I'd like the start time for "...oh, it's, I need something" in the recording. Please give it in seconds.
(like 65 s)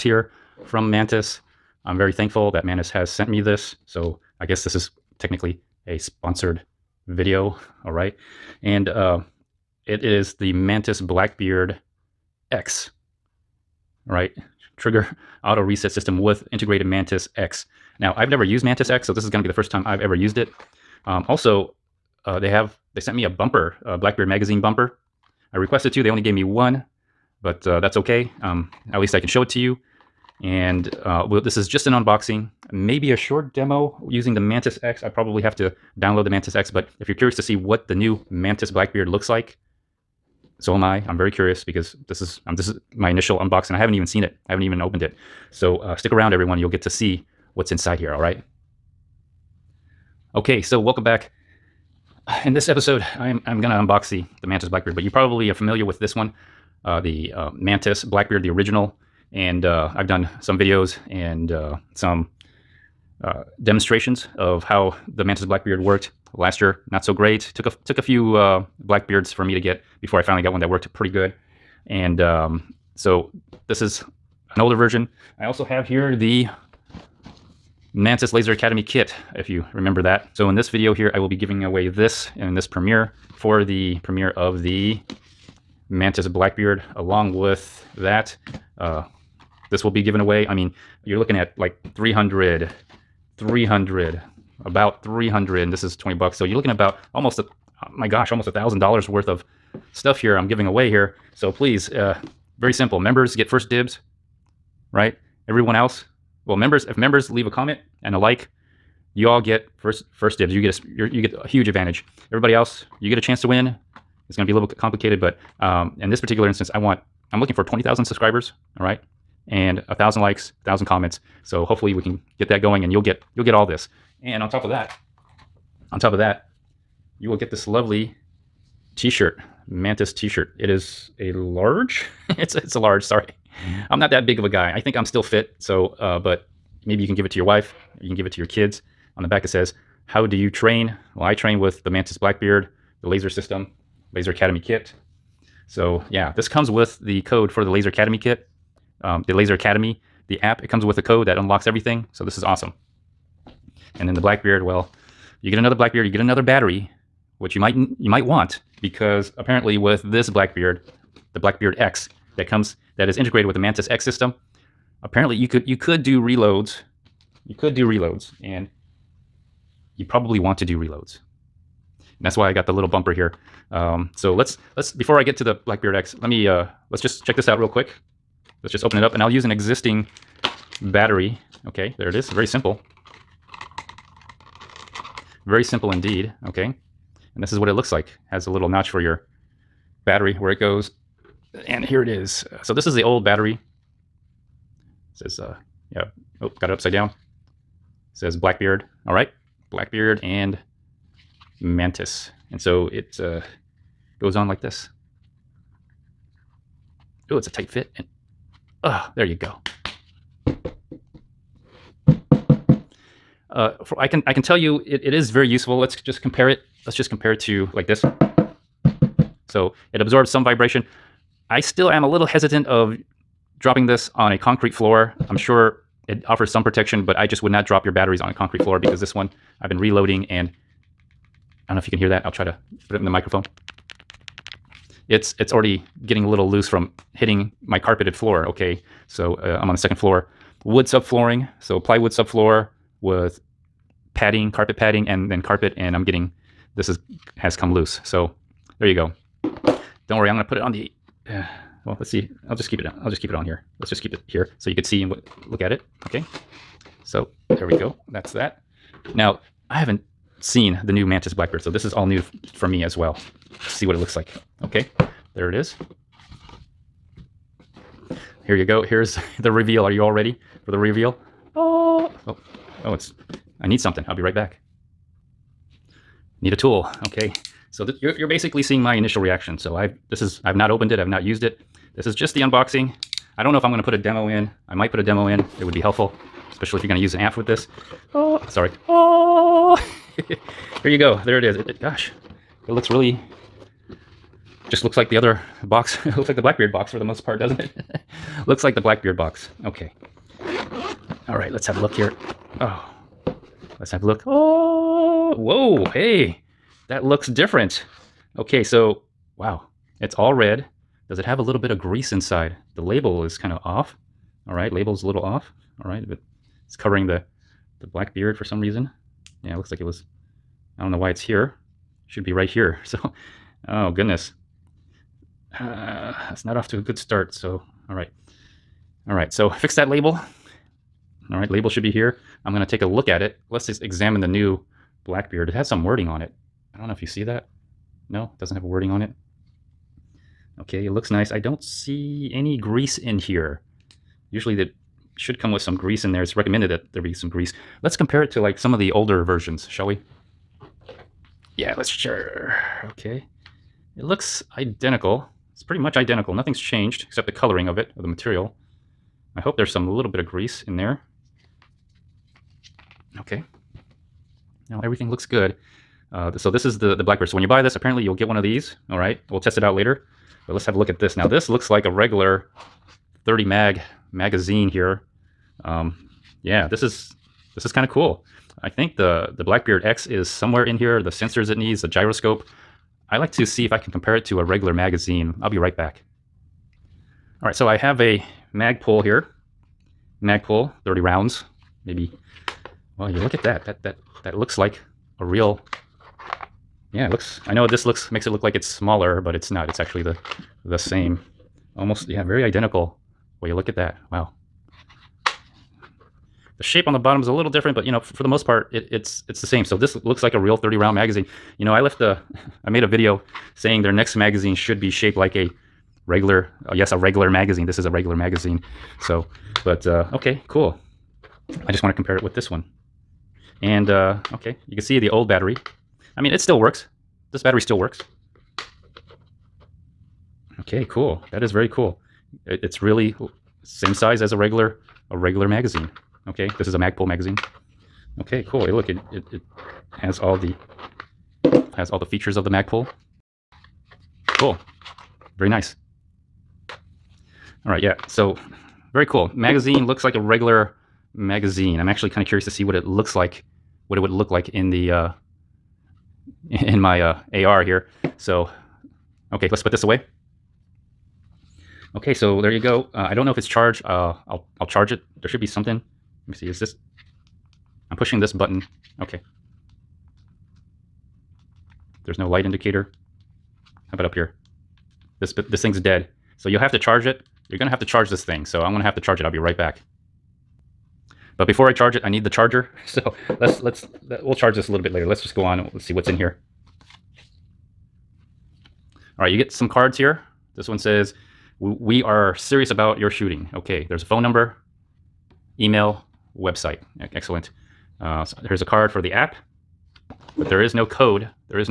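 272 s.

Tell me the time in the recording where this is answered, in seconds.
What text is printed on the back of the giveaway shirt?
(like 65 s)
140 s.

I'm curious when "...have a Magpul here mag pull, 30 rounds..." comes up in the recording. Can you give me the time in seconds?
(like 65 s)
387 s.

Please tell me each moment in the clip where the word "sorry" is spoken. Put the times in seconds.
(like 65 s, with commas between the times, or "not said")
133 s, 288 s.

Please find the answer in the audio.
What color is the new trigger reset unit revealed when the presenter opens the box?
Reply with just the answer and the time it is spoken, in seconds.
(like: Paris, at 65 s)
Red, at 310 s.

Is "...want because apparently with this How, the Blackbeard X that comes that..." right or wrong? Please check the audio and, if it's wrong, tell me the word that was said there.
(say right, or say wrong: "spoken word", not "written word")
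wrong: "Blackbeard", not "How".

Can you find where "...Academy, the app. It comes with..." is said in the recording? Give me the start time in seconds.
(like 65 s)
149 s.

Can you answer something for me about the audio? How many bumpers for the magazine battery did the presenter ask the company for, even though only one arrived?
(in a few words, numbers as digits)
2.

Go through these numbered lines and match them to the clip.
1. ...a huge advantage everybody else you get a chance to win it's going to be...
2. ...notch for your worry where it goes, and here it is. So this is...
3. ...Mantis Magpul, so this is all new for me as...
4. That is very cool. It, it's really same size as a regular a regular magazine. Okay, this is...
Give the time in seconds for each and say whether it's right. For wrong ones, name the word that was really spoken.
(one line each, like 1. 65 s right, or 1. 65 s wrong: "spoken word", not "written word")
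1. 111 s right
2. 188 s wrong: "battery", not "worry"
3. 261 s wrong: "Blackbeard", not "Magpul"
4. 431 s right.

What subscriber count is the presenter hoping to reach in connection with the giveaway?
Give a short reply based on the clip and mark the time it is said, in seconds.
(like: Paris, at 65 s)
20,000, at 117 s.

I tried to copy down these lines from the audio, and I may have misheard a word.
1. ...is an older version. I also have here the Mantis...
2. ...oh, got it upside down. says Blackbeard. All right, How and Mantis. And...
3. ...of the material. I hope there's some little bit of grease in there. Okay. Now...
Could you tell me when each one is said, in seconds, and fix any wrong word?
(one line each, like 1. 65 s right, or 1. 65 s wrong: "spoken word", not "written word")
1. 73 s right
2. 196 s wrong: "Blackbeard", not "How"
3. 357 s right.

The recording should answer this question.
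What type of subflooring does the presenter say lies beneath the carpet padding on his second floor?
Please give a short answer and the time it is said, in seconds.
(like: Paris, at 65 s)
Plywood, at 241 s.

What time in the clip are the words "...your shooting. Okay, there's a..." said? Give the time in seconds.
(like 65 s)
492 s.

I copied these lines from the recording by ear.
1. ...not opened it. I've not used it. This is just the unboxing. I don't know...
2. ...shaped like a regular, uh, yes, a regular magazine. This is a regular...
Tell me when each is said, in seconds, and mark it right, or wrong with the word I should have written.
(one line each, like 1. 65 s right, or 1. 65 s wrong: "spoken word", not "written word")
1. 280 s right
2. 414 s right.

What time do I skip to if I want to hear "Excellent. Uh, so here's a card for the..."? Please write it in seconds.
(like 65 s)
497 s.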